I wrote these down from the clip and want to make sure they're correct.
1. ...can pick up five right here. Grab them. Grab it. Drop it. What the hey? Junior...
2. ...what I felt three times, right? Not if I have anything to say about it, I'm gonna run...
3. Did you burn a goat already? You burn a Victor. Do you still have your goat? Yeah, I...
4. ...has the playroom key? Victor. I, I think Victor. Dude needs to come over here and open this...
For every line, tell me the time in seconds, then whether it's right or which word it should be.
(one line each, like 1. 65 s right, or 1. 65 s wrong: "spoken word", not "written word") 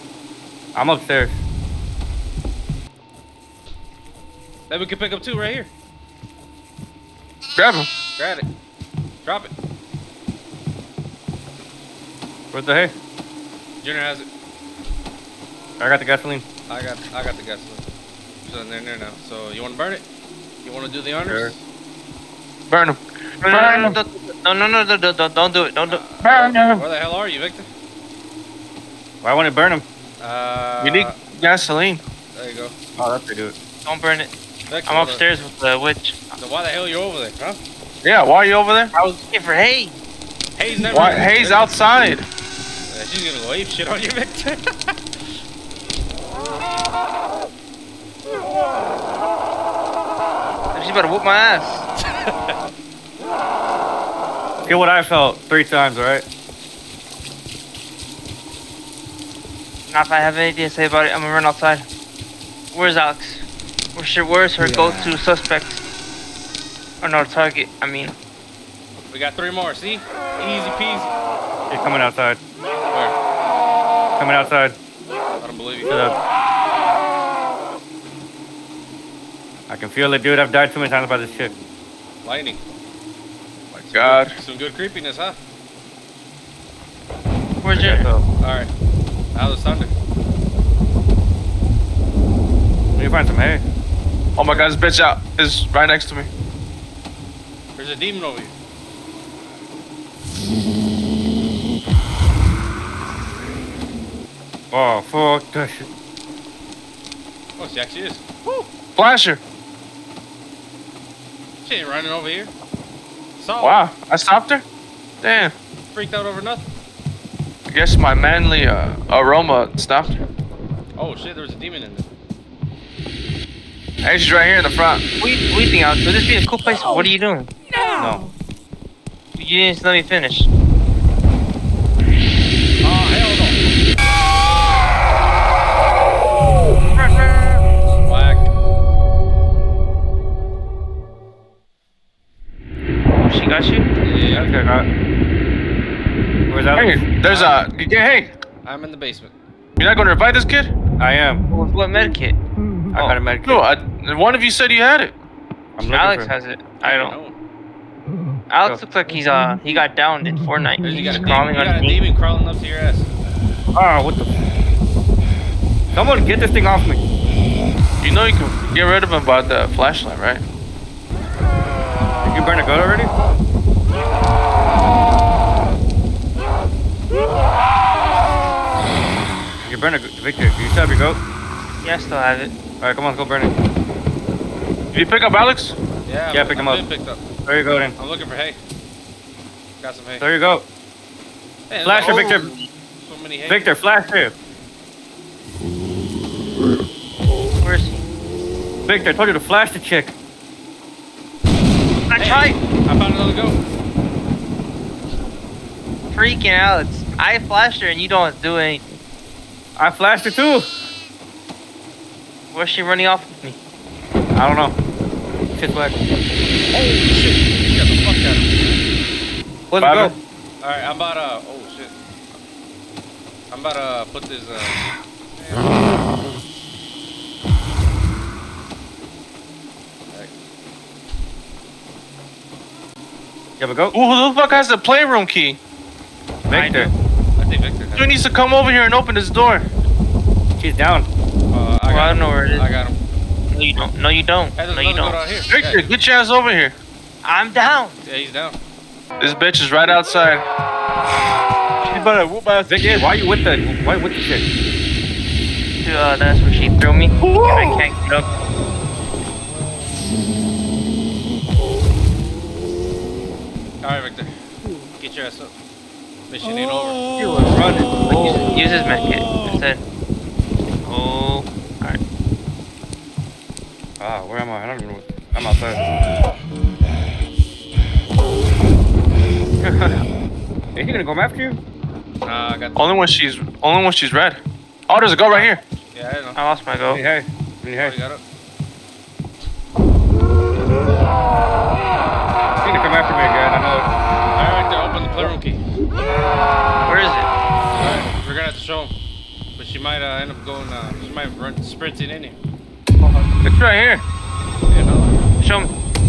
1. 4 s wrong: "two", not "five"
2. 54 s right
3. 170 s right
4. 234 s right.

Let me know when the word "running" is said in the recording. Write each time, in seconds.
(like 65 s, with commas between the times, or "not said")
111 s, 212 s, 267 s.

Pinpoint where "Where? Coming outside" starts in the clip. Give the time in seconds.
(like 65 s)
72 s.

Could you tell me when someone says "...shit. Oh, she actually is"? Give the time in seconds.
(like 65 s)
105 s.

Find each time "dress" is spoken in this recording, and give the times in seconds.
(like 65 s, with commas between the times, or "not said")
not said.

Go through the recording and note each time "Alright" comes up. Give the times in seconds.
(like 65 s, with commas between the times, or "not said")
88 s, 182 s, 220 s, 263 s.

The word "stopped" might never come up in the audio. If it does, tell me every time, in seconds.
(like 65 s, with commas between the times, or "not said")
114 s, 119 s.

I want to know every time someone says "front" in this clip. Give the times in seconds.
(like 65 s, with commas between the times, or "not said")
124 s.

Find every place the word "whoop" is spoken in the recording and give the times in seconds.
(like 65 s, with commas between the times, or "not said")
51 s, 252 s.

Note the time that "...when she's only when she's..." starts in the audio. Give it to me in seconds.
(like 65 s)
282 s.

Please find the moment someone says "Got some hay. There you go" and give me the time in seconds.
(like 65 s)
189 s.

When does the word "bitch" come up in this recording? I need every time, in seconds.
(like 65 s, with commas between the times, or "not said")
94 s, 249 s.